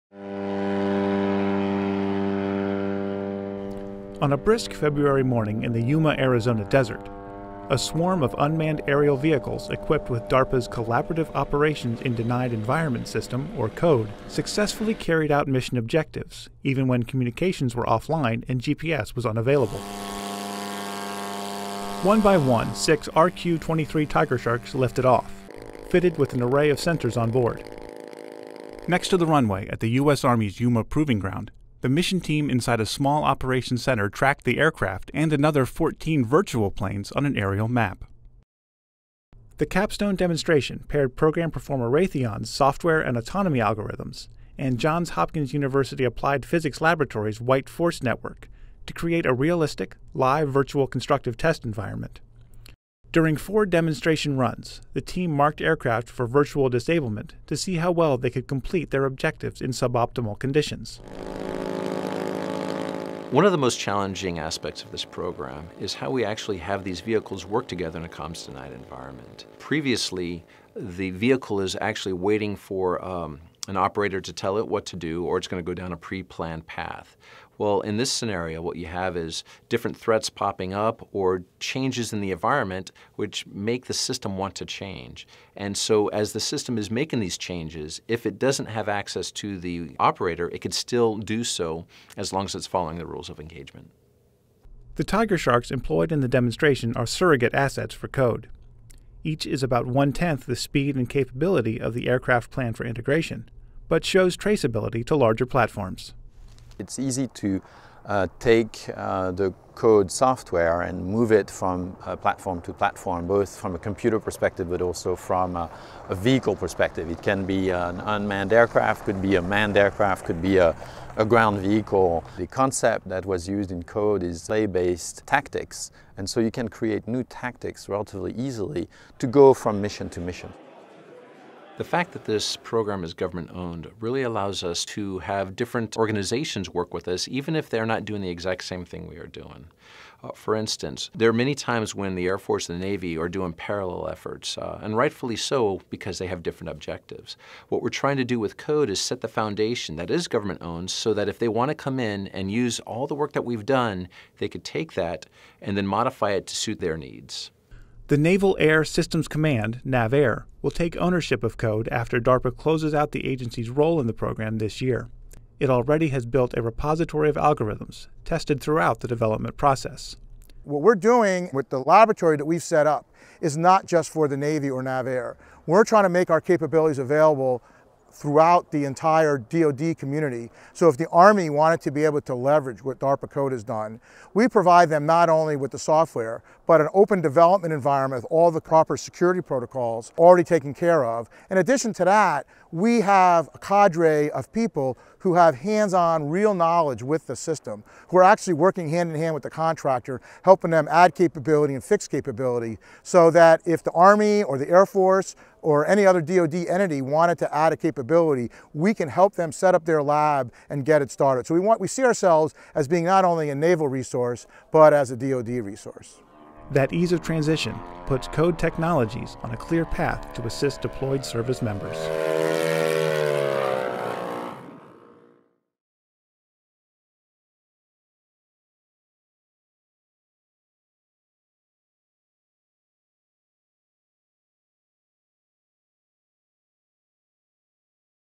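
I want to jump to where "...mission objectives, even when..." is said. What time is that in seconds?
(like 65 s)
15 s.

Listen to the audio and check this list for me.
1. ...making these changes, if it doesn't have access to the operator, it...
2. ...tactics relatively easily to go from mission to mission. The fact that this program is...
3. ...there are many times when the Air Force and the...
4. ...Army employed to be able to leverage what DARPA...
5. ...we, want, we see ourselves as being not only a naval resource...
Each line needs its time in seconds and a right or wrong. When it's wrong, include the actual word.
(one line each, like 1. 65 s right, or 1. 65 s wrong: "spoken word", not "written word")
1. 86 s right
2. 127 s right
3. 141 s right
4. 181 s wrong: "wanted", not "employed"
5. 211 s right.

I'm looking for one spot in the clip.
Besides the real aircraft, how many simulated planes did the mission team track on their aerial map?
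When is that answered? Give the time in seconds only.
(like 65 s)
35 s.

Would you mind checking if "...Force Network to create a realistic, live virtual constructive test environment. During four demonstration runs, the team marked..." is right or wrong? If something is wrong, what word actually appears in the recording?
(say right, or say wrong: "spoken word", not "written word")
right.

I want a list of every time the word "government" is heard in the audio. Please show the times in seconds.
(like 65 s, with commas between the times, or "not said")
133 s, 150 s.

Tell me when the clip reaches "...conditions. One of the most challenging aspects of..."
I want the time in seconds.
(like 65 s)
60 s.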